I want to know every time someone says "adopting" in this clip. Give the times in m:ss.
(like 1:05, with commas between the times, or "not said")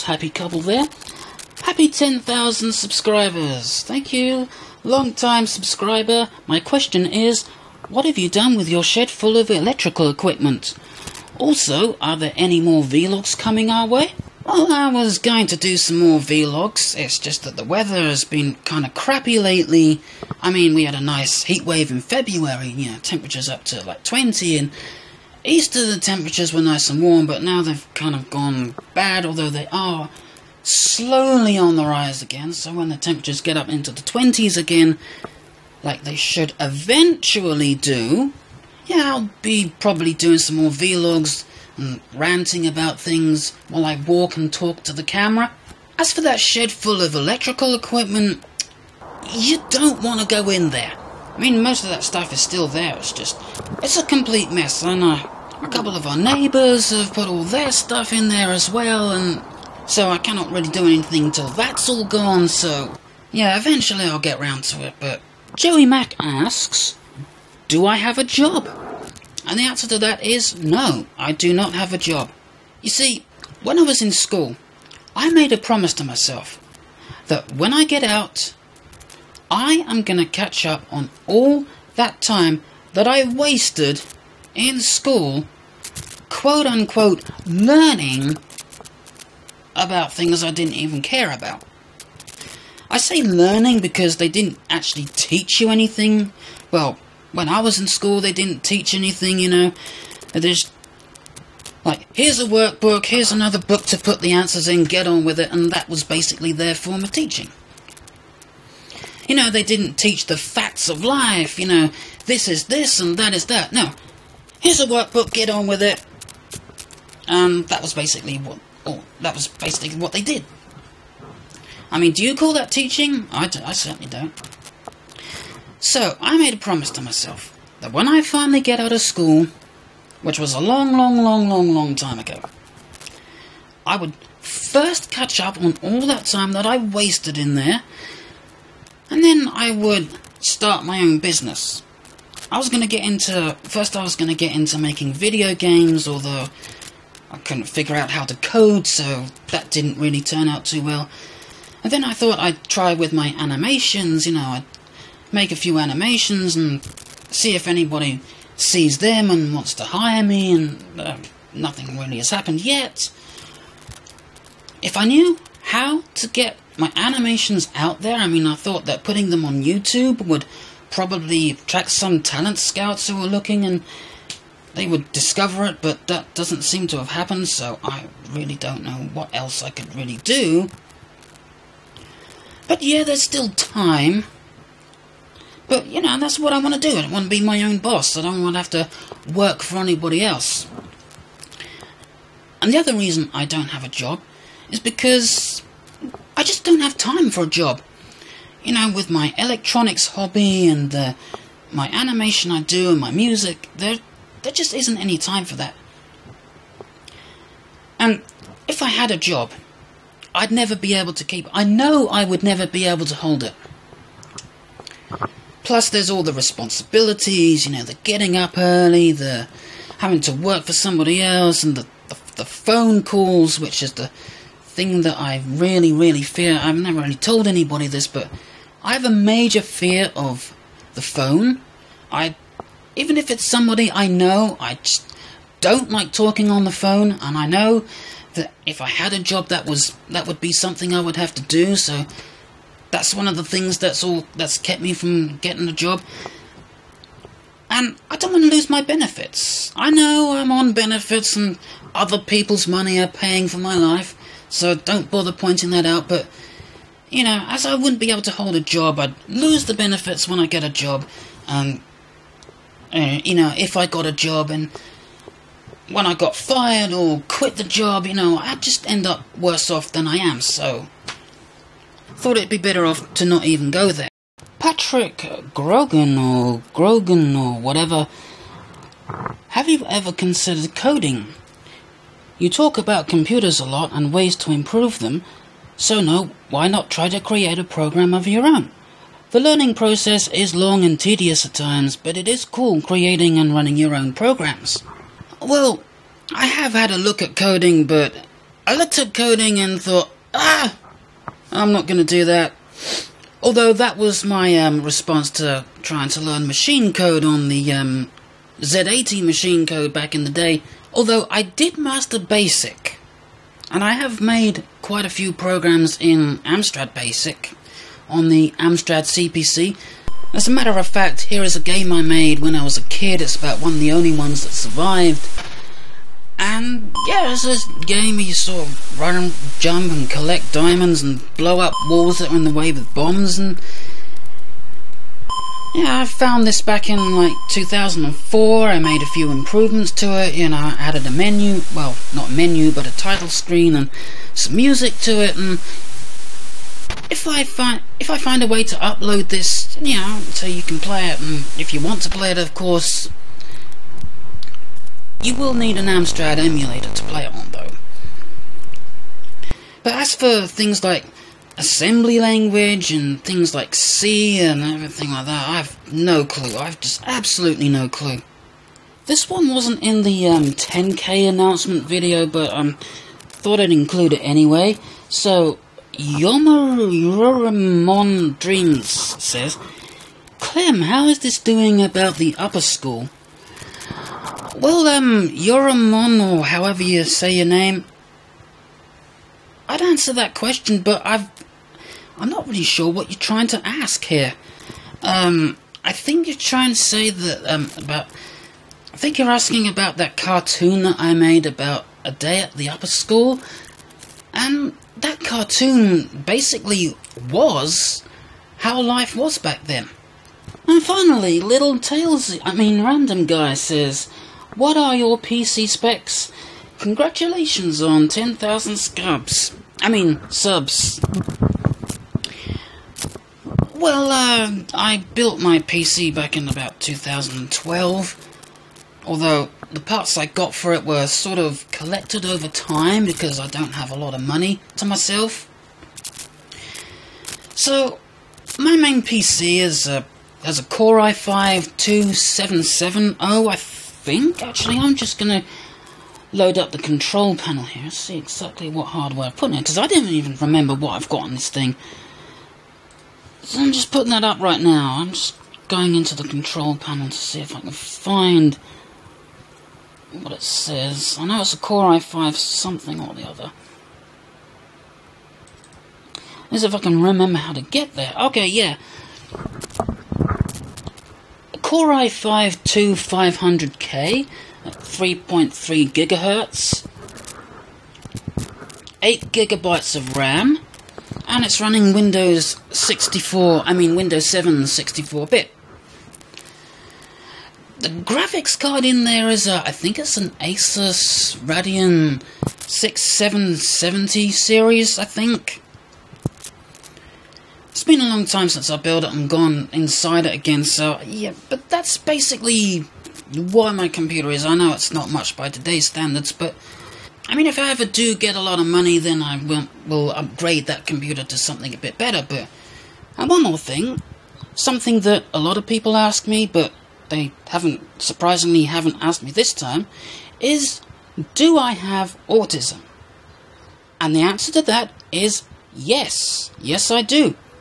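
not said.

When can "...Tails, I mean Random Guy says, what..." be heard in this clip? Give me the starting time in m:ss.
6:51.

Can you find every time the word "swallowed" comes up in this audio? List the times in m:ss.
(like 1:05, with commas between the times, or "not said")
not said.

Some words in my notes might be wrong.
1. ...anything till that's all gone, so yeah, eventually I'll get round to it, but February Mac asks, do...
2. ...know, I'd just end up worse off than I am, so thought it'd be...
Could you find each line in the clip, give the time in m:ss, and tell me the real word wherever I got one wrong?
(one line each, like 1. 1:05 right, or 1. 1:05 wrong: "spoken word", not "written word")
1. 1:00 wrong: "Joey", not "February"
2. 4:28 right.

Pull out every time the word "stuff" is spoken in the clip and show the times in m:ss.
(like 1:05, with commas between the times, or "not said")
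0:52, 0:57.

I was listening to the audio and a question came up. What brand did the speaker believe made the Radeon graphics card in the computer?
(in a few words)
Asus.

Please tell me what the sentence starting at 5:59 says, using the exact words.
But as for things like assembly language and things like C and everything like that, I've no clue.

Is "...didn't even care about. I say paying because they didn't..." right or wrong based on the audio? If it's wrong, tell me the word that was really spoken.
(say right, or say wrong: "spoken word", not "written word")
wrong: "learning", not "paying".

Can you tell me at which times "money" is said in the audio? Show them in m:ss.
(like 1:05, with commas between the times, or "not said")
4:12, 7:14, 8:28.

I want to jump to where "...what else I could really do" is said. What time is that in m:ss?
2:59.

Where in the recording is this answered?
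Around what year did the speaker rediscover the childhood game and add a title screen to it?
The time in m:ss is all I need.
5:37.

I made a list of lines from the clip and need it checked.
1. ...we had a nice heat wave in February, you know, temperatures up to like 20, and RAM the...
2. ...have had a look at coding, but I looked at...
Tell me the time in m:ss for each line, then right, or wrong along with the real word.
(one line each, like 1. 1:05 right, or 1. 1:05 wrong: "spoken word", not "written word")
1. 0:20 wrong: "Easter", not "RAM"
2. 4:56 right.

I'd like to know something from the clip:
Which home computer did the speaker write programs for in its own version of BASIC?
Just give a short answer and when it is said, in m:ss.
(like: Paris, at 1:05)
Amstrad CPC, at 5:18.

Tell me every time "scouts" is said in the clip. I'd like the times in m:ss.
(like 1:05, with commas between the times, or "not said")
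2:52.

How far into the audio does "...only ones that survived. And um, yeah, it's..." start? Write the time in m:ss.
5:23.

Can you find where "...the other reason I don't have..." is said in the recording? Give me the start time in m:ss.
3:12.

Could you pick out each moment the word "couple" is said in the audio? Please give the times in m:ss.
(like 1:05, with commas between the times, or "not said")
0:00, 0:55.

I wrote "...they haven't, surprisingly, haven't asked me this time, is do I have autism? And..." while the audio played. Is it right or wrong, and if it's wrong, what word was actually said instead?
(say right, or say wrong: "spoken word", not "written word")
right.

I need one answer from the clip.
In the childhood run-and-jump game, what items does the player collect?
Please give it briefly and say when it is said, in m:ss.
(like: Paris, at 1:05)
diamonds, at 5:30.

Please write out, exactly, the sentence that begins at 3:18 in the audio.
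You know, with my electronics hobby and my animation I do and my music, there, there just isn't any time for that.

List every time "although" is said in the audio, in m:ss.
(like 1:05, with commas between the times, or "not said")
0:29, 2:26, 5:03, 5:10, 7:09.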